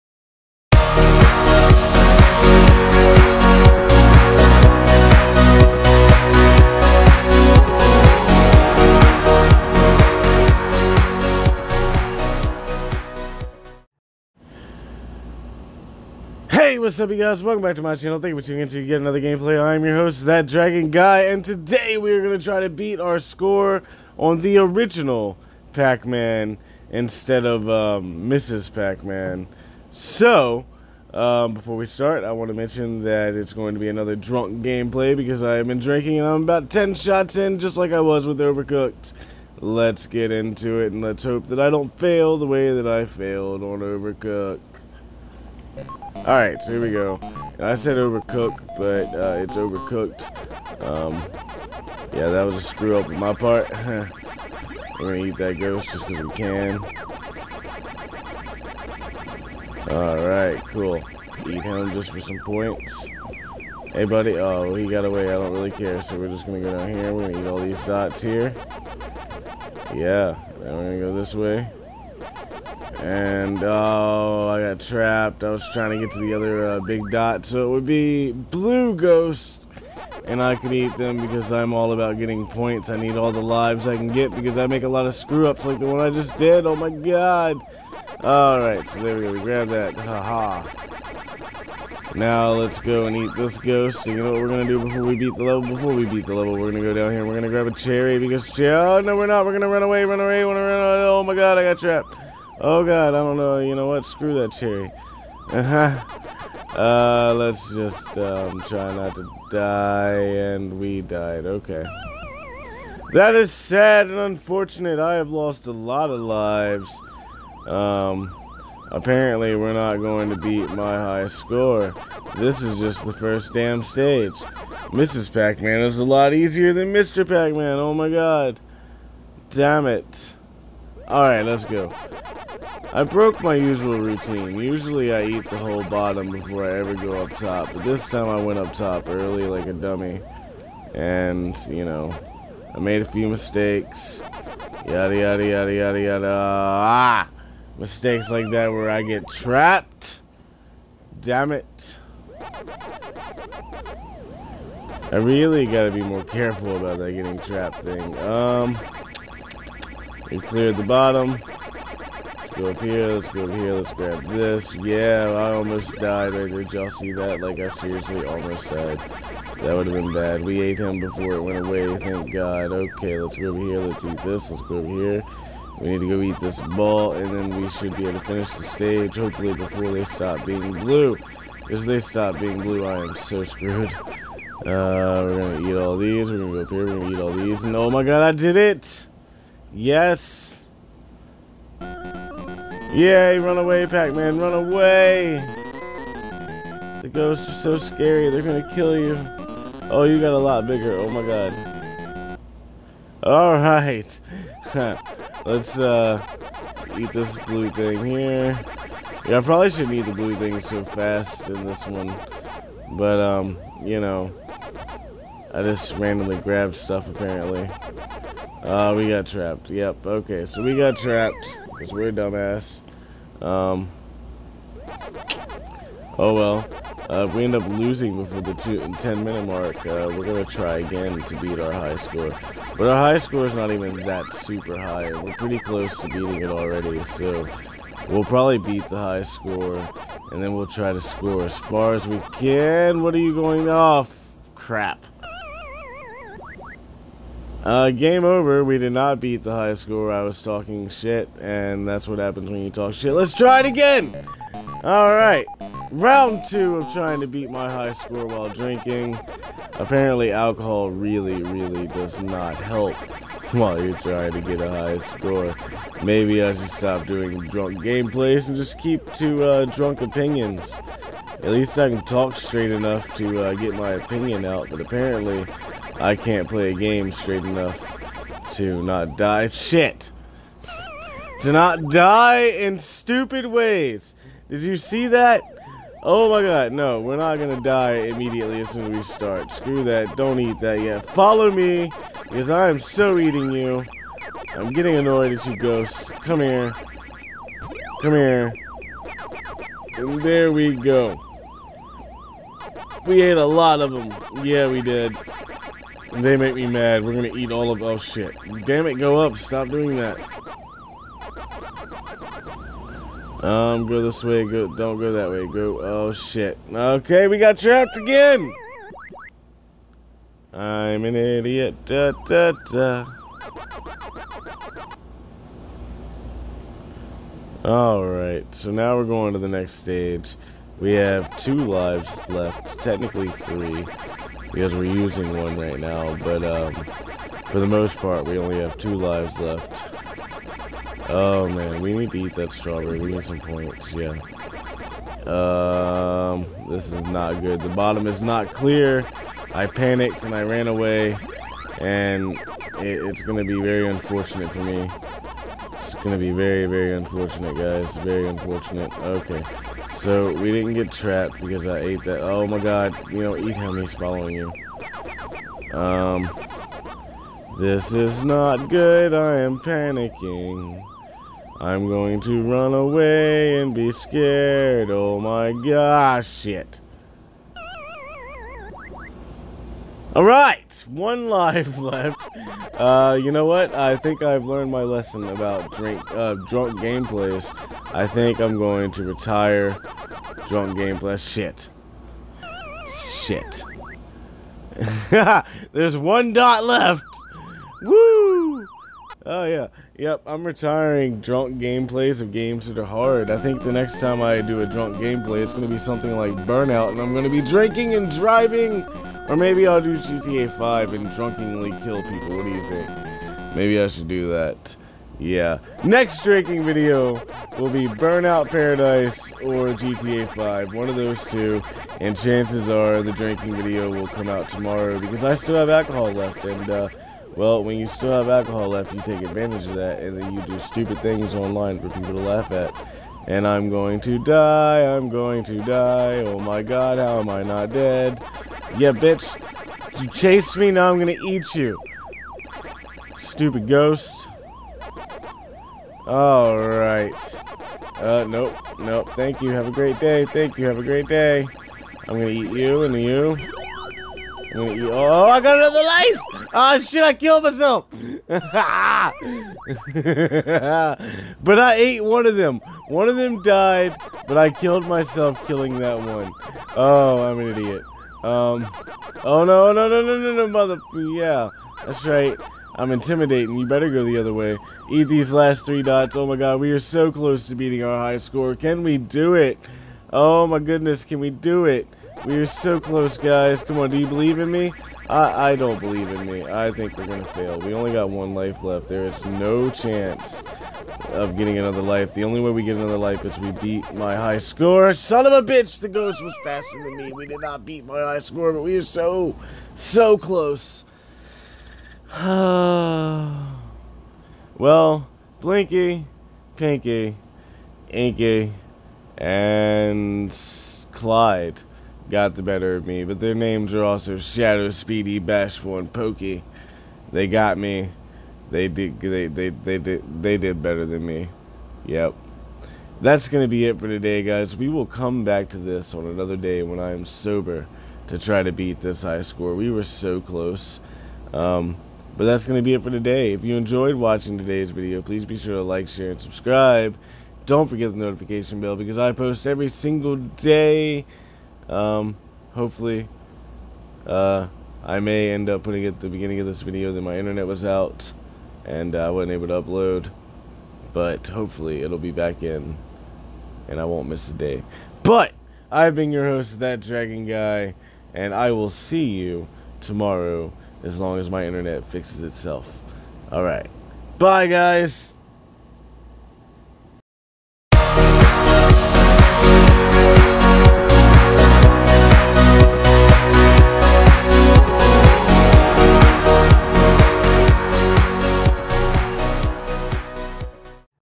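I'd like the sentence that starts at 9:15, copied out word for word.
But I've been your host, That Dragon Guy, and I will see you tomorrow as long as my internet fixes itself.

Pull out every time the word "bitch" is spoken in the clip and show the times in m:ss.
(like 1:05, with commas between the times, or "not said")
7:18, 8:15.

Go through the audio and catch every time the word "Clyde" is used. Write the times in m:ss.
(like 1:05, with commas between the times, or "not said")
8:30.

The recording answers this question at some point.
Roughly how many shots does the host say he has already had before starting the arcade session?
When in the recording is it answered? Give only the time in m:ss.
0:36.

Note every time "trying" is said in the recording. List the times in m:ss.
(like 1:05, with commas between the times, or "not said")
1:15, 4:16, 4:23.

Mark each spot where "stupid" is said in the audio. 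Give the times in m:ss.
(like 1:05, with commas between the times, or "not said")
4:42, 7:10, 7:23.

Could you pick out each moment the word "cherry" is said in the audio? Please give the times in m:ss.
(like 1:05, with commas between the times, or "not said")
1:37, 1:44.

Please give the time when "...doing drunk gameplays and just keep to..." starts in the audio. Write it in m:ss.
4:27.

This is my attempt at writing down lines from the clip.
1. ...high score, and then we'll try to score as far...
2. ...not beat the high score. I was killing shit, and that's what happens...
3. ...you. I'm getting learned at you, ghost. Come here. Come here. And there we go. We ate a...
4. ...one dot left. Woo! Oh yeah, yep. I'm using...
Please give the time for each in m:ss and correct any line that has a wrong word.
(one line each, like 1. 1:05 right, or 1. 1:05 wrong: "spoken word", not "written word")
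1. 3:58 right
2. 4:08 wrong: "talking", not "killing"
3. 4:53 wrong: "annoyed", not "learned"
4. 6:35 wrong: "retiring", not "using".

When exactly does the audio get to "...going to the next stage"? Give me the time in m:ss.
5:29.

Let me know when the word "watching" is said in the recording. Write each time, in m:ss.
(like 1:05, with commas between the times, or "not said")
8:53.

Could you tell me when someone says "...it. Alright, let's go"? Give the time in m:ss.
2:09.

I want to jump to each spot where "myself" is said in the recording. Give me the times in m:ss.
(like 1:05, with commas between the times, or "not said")
7:37, 7:44.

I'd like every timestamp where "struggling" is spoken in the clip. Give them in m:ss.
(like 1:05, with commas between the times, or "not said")
not said.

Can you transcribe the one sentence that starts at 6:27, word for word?
I think I'm going to retire drunk gameplay.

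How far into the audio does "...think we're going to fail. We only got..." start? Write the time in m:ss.
8:06.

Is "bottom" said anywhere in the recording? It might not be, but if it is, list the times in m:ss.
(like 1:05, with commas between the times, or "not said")
2:15, 2:40, 5:47.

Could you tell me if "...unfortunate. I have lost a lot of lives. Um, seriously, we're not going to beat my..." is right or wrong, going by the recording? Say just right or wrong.
wrong.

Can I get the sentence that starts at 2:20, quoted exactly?
And, you know, I made a few mistakes.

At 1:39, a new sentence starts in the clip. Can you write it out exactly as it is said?
We're gonna run away, run away, run away.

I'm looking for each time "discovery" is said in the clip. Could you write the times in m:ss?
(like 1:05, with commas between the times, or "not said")
not said.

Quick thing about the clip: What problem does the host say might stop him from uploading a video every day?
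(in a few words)
internet was out.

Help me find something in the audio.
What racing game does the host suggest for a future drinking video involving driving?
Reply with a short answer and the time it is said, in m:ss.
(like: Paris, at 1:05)
Burnout Paradise, at 6:57.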